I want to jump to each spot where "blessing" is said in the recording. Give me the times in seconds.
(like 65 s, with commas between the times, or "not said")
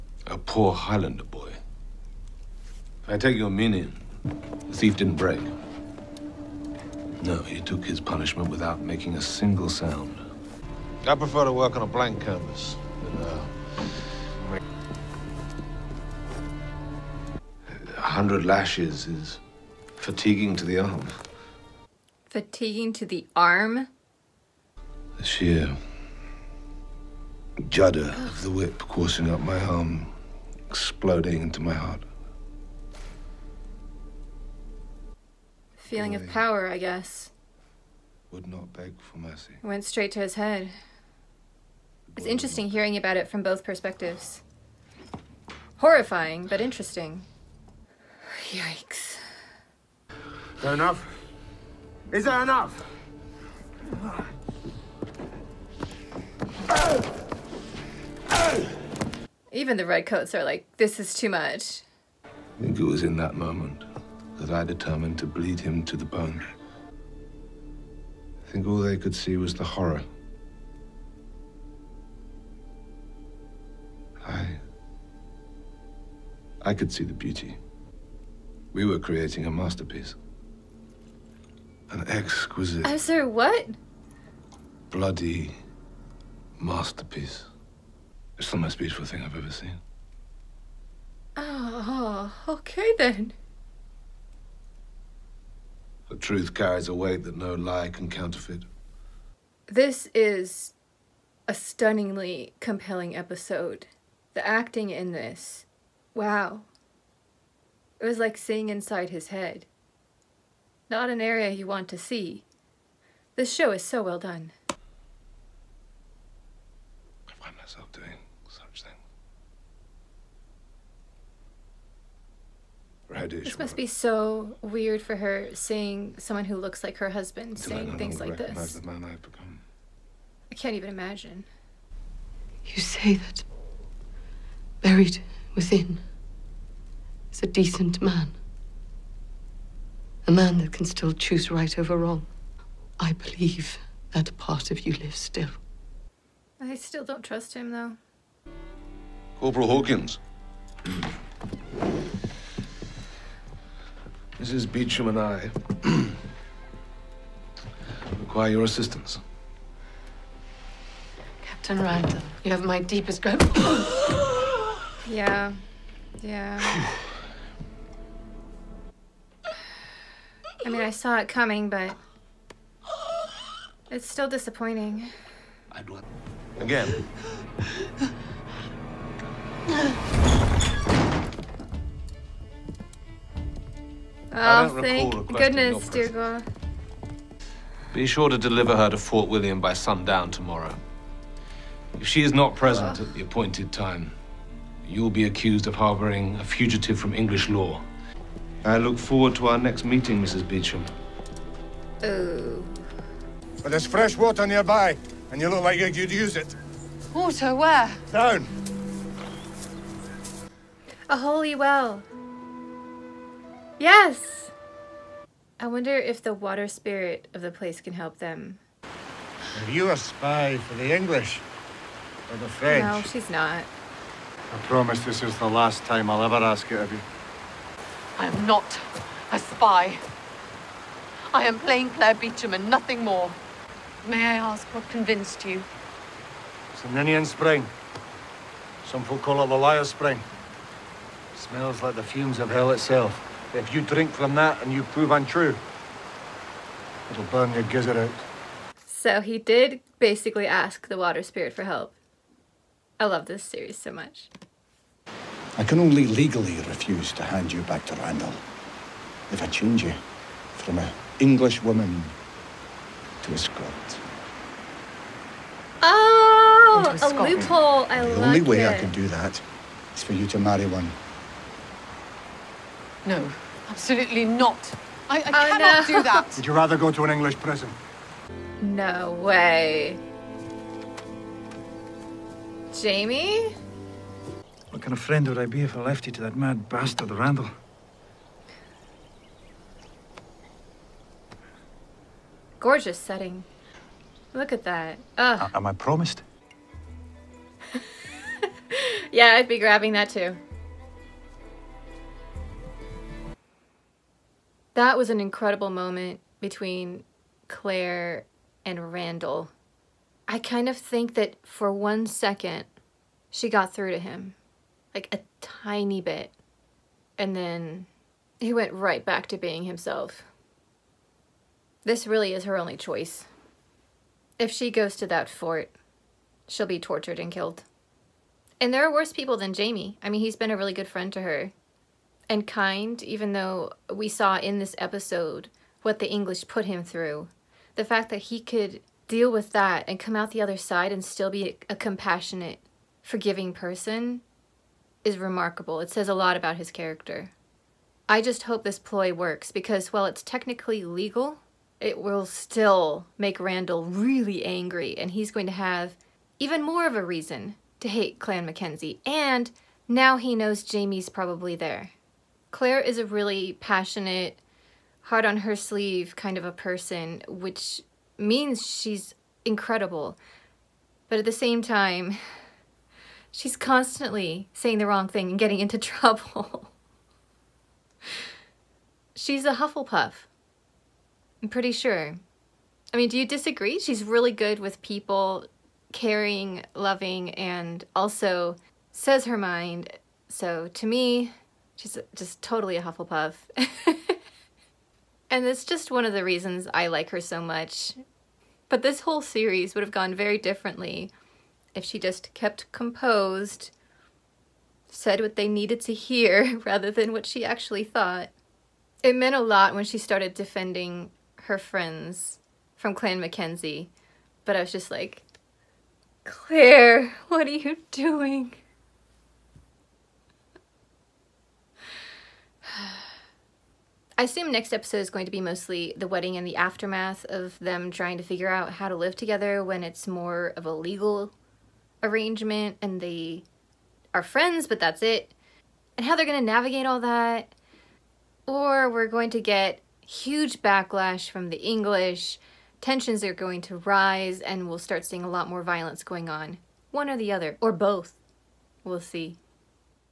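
not said.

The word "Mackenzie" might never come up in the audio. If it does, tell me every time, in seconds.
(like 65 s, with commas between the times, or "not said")
358 s, 413 s.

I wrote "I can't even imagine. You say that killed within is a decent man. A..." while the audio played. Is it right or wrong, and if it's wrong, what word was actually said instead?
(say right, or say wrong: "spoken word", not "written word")
wrong: "buried", not "killed".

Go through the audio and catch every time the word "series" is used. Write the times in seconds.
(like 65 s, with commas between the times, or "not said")
253 s, 399 s.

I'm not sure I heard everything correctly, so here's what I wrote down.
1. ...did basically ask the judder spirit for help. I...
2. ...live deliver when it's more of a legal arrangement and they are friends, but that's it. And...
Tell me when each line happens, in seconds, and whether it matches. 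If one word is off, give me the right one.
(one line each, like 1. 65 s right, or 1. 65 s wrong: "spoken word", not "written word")
1. 249 s wrong: "water", not "judder"
2. 428 s wrong: "together", not "deliver".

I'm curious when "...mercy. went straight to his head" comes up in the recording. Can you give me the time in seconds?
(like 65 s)
39 s.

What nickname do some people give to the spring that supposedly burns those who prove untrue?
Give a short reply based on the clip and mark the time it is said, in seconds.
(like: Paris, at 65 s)
Liar Spring, at 239 s.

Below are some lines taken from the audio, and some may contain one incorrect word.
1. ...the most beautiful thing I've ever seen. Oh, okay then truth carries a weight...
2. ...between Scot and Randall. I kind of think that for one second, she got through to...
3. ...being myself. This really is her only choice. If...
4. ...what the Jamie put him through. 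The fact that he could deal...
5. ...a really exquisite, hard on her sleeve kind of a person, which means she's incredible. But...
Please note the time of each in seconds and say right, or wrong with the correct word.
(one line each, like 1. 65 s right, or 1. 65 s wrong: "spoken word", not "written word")
1. 88 s right
2. 306 s wrong: "Claire", not "Scot"
3. 319 s wrong: "himself", not "myself"
4. 335 s wrong: "English", not "Jamie"
5. 362 s wrong: "passionate", not "exquisite".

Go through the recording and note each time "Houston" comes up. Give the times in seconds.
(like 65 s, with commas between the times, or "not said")
not said.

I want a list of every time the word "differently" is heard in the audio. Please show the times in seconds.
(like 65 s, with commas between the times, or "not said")
400 s.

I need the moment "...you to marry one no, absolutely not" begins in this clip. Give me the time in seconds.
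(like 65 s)
270 s.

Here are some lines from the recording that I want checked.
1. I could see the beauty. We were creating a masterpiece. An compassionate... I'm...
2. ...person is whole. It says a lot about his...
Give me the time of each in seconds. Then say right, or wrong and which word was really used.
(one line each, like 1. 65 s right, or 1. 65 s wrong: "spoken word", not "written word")
1. 76 s wrong: "exquisite", not "compassionate"
2. 343 s wrong: "remarkable", not "whole".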